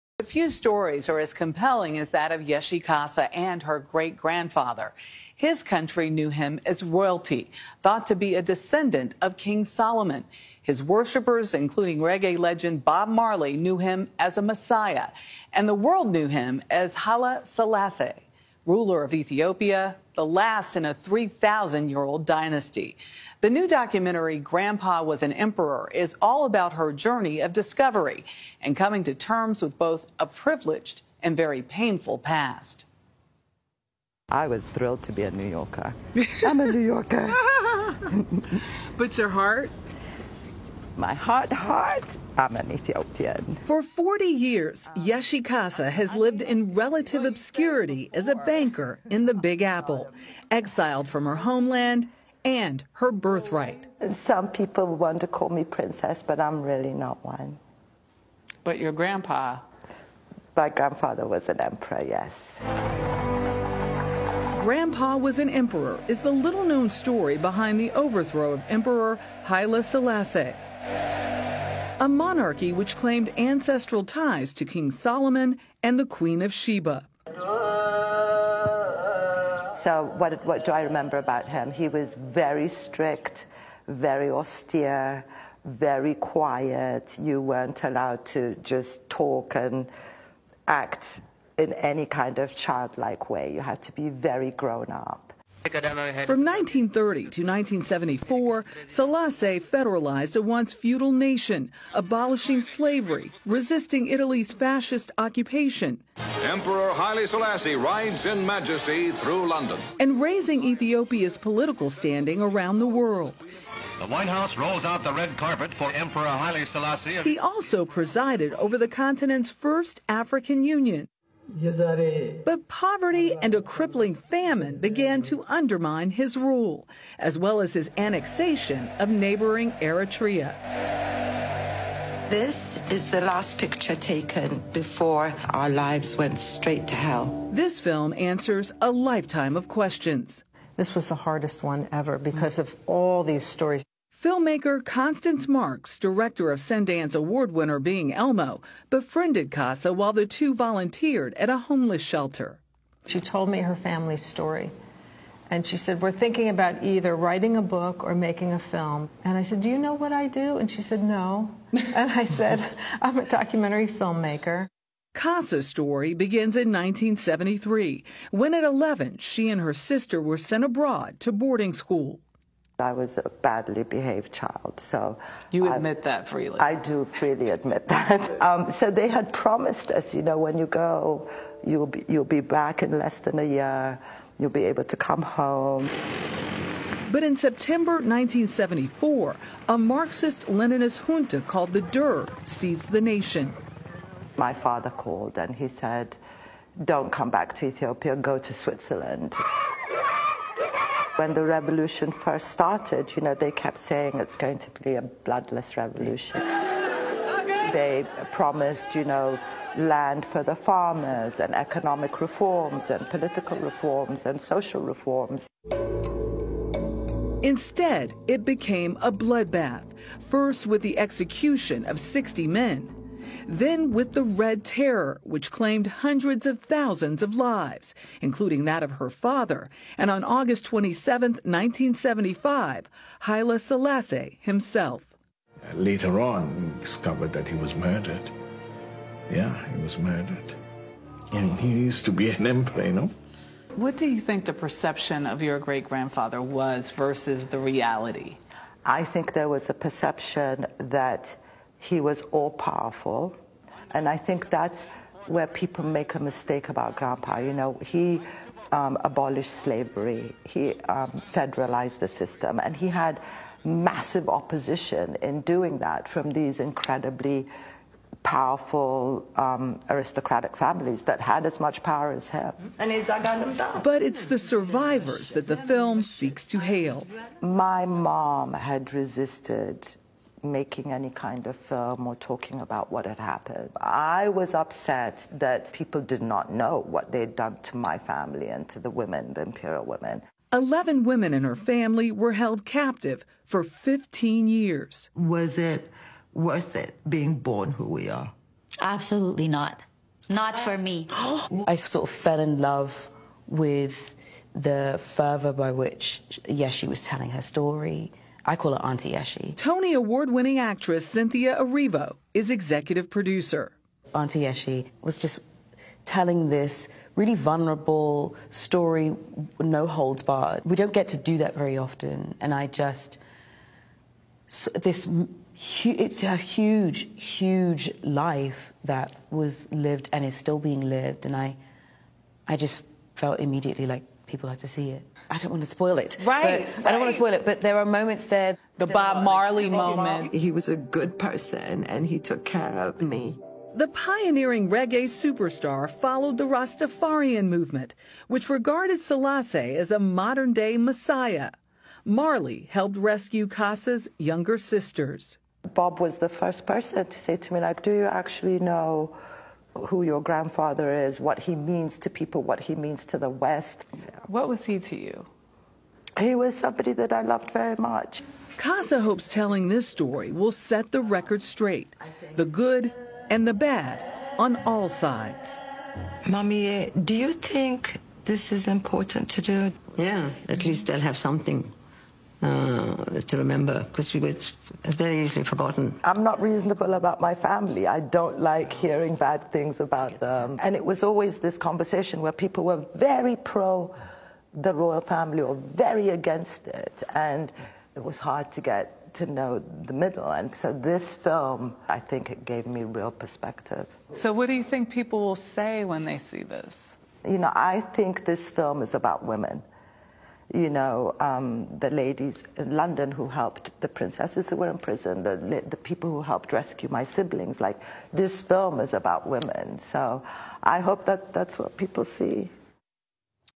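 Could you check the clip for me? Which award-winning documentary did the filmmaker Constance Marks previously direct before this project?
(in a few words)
Being Elmo.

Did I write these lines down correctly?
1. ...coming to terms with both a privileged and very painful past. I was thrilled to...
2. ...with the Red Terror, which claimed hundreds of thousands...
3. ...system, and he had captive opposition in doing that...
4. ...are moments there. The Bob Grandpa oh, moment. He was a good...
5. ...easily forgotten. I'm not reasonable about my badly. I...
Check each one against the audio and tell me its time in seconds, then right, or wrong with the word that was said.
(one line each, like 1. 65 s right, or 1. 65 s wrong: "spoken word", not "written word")
1. 28 s right
2. 223 s right
3. 262 s wrong: "massive", not "captive"
4. 337 s wrong: "Marley", not "Grandpa"
5. 385 s wrong: "family", not "badly".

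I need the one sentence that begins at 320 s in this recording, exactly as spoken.
We don't get to do that very often, and I just.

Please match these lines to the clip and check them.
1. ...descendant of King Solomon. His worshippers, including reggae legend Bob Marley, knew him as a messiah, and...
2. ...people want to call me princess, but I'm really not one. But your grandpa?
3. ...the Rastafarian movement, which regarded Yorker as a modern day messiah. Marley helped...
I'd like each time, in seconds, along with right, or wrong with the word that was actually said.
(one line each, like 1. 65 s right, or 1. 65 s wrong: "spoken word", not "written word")
1. 8 s right
2. 54 s right
3. 346 s wrong: "Selassie", not "Yorker".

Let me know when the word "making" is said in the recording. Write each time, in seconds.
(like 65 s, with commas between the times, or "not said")
158 s, 280 s.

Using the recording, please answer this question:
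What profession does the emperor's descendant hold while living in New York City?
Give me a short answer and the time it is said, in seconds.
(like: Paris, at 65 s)
Banker, at 48 s.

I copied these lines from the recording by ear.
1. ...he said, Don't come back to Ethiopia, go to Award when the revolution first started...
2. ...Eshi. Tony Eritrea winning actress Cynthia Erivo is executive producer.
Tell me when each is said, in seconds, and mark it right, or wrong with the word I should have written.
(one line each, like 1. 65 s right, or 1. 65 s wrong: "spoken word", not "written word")
1. 195 s wrong: "Switzerland", not "Award"
2. 309 s wrong: "Award", not "Eritrea".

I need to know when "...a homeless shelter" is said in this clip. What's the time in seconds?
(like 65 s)
151 s.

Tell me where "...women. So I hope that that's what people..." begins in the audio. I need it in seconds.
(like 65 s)
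419 s.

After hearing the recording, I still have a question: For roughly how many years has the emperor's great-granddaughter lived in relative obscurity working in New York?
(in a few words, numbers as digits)
40.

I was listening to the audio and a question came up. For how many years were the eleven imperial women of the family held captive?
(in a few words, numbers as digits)
15.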